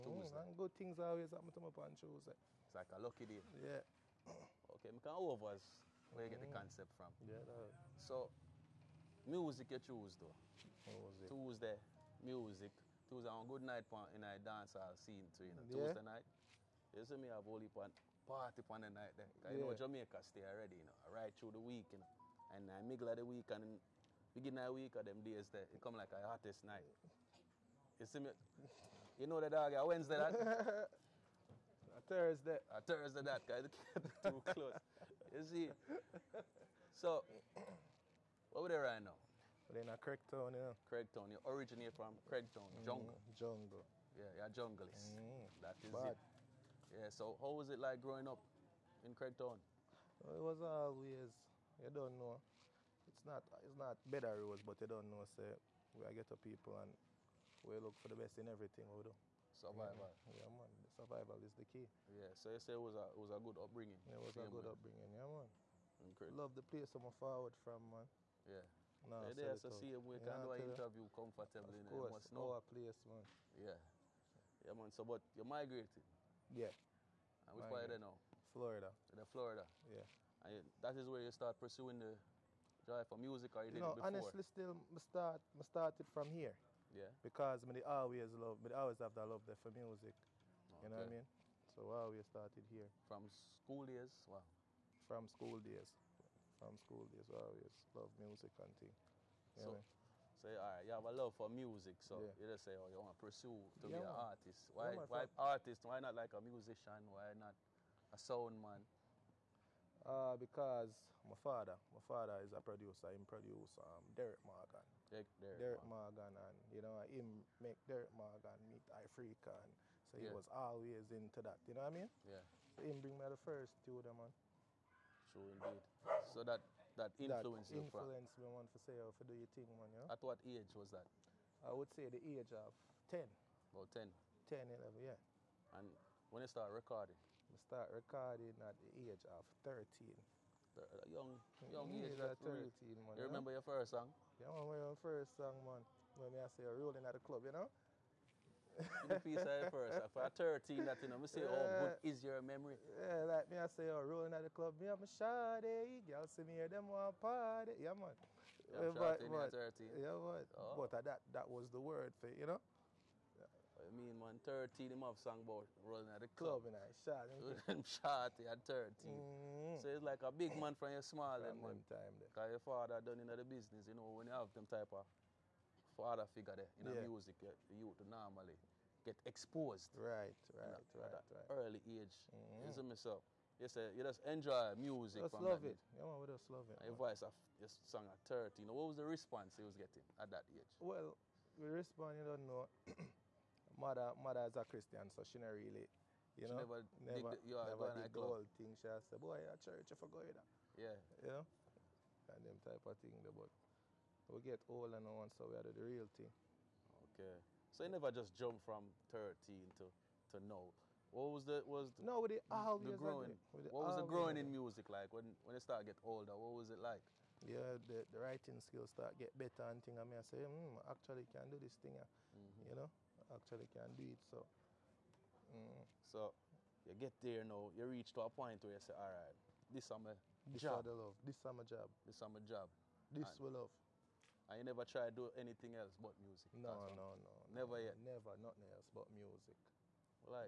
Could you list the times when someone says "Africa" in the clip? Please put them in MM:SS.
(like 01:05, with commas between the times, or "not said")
01:58.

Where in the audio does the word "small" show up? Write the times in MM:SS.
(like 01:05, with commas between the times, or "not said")
02:51.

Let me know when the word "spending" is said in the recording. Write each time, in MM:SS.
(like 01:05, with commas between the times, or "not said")
not said.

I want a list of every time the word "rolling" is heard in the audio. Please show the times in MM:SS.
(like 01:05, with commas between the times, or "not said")
02:26, 02:33.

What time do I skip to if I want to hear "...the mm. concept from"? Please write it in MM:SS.
00:06.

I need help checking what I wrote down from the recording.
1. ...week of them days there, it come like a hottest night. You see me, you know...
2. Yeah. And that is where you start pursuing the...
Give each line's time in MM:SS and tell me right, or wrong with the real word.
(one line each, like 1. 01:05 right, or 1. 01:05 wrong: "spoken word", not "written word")
1. 00:24 right
2. 01:19 right.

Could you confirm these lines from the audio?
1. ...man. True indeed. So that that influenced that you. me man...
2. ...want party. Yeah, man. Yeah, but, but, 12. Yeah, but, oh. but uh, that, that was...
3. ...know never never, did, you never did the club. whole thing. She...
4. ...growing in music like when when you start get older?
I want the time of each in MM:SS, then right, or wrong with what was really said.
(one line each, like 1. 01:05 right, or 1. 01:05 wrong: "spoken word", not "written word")
1. 02:04 right
2. 02:36 wrong: "13", not "12"
3. 03:16 right
4. 03:34 right.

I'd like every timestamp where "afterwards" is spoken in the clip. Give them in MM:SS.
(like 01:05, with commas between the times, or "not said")
not said.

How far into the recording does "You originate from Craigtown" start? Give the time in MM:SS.
00:41.